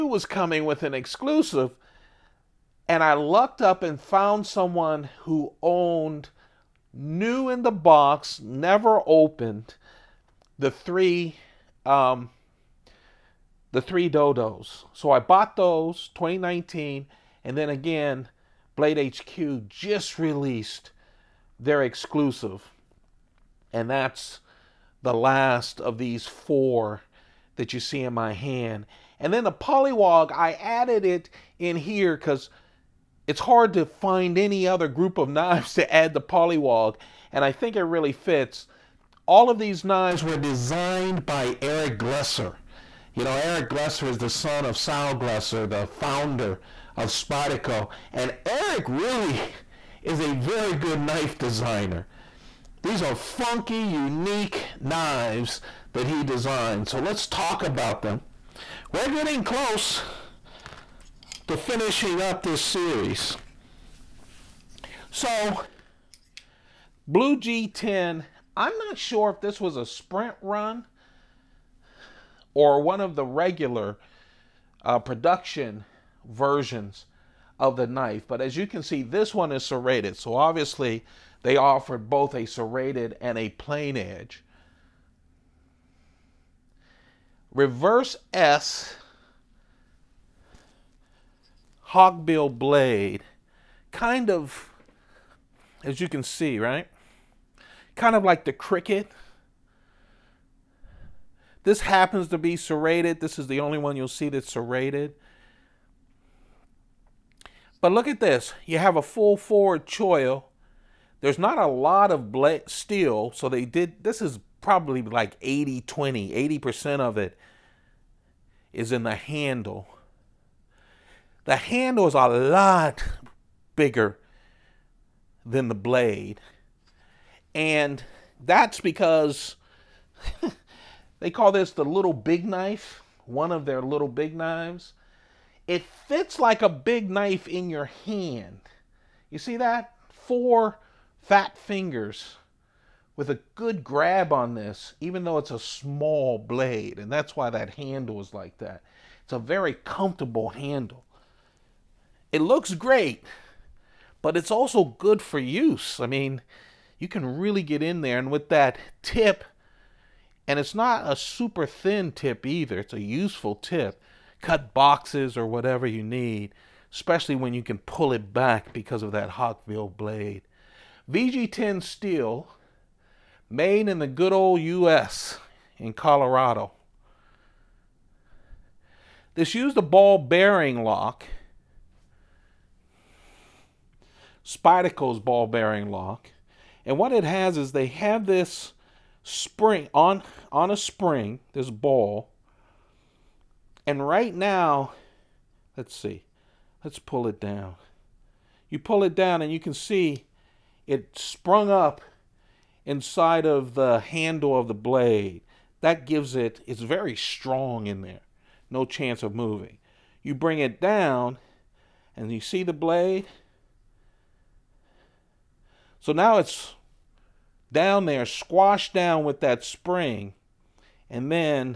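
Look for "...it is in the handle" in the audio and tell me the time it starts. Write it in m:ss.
1:57.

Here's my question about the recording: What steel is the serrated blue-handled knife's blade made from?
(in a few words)
VG10.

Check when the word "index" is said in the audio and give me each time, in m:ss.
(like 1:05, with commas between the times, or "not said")
not said.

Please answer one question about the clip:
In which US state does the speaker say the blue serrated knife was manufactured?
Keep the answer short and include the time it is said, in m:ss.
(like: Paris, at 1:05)
Colorado, at 2:55.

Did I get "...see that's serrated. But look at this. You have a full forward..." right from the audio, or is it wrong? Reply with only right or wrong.
right.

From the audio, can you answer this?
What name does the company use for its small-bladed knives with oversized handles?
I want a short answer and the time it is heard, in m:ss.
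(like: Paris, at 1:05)
little big knife, at 2:11.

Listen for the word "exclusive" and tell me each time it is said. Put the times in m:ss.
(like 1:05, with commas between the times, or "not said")
0:00, 0:21.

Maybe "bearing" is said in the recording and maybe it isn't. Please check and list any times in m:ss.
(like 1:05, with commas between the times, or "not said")
3:00, 3:05.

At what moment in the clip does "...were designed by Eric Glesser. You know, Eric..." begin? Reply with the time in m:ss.
0:40.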